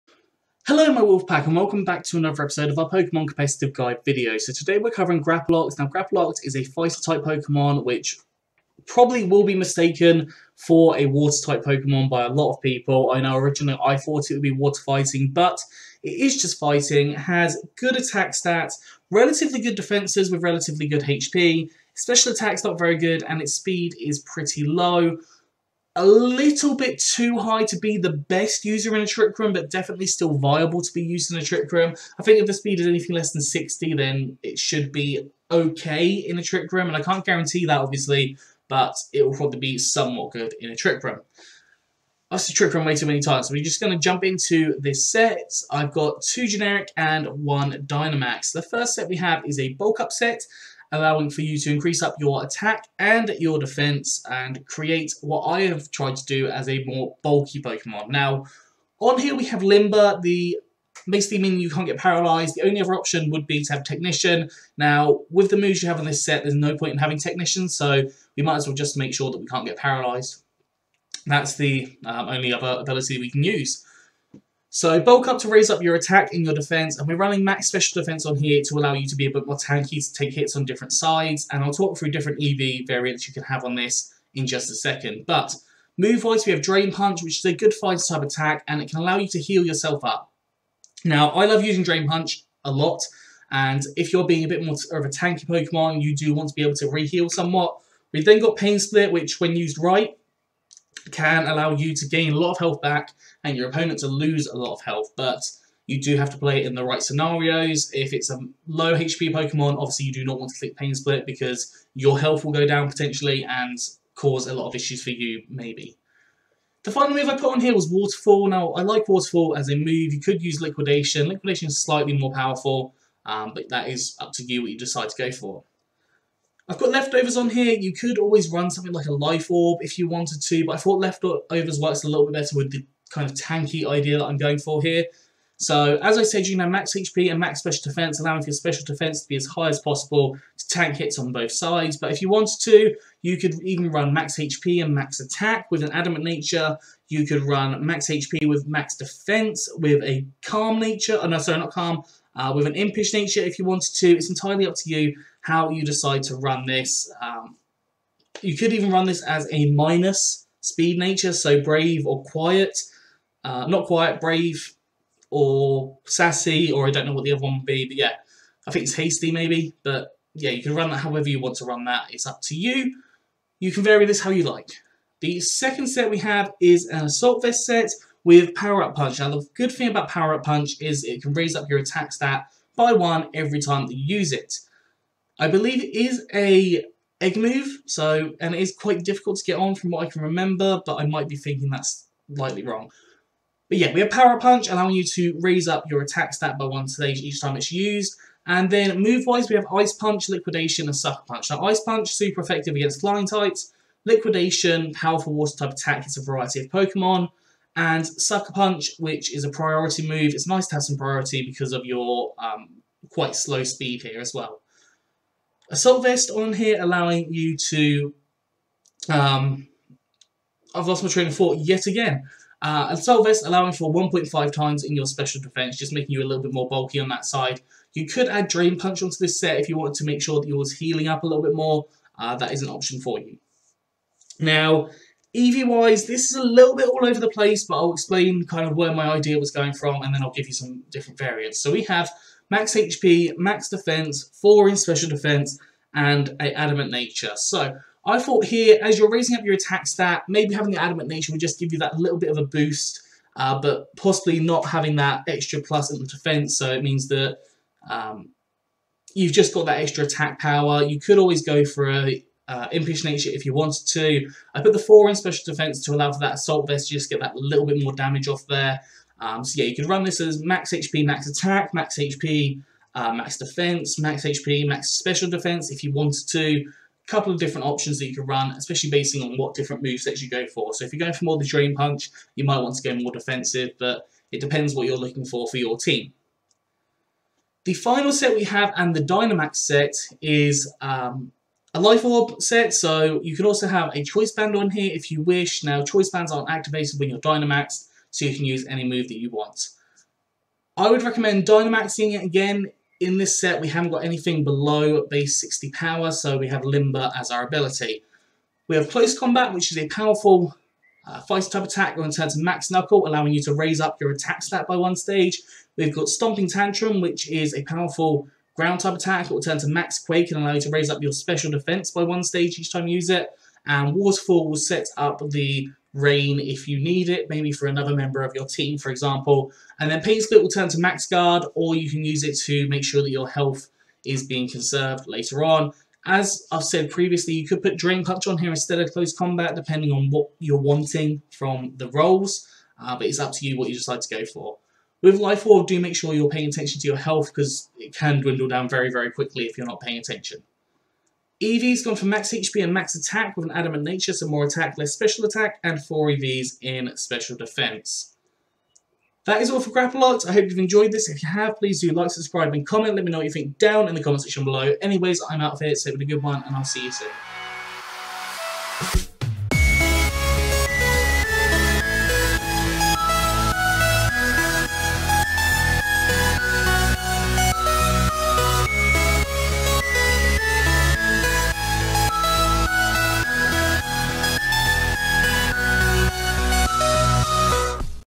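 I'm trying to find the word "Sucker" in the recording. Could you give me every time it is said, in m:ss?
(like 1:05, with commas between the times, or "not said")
3:20, 3:28.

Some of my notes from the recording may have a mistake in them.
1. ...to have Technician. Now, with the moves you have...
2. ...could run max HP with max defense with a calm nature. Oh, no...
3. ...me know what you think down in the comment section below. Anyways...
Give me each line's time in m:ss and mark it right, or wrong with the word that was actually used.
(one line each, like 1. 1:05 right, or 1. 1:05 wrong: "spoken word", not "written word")
1. 1:03 right
2. 2:27 right
3. 6:03 right.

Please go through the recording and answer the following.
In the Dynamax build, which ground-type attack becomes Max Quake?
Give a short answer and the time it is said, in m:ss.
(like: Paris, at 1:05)
Stomping Tantrum, at 5:16.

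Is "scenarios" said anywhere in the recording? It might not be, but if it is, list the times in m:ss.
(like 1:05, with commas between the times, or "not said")
1:47.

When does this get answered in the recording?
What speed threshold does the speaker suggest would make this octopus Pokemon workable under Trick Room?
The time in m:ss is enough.
0:33.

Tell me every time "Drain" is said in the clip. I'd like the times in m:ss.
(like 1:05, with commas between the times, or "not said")
1:26, 1:31, 3:48, 4:41, 5:37.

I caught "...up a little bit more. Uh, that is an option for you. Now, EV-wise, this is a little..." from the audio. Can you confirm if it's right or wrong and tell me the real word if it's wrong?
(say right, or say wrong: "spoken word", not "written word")
right.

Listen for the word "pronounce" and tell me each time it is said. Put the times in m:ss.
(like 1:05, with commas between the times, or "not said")
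not said.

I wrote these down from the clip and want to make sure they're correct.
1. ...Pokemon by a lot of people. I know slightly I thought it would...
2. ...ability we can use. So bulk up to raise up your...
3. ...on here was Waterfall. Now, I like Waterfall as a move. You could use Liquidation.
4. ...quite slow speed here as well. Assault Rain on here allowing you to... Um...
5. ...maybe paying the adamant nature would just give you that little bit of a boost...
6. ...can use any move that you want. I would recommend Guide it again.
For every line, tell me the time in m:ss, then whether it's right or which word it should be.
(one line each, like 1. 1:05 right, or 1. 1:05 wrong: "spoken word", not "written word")
1. 0:11 wrong: "originally", not "slightly"
2. 1:12 right
3. 1:57 right
4. 3:33 wrong: "Vest", not "Rain"
5. 4:10 wrong: "having", not "paying"
6. 4:58 wrong: "Dynamaxing", not "Guide".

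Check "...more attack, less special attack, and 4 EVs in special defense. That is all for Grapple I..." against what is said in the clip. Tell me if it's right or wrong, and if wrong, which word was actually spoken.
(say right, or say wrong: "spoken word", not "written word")
right.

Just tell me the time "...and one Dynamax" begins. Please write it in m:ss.
0:46.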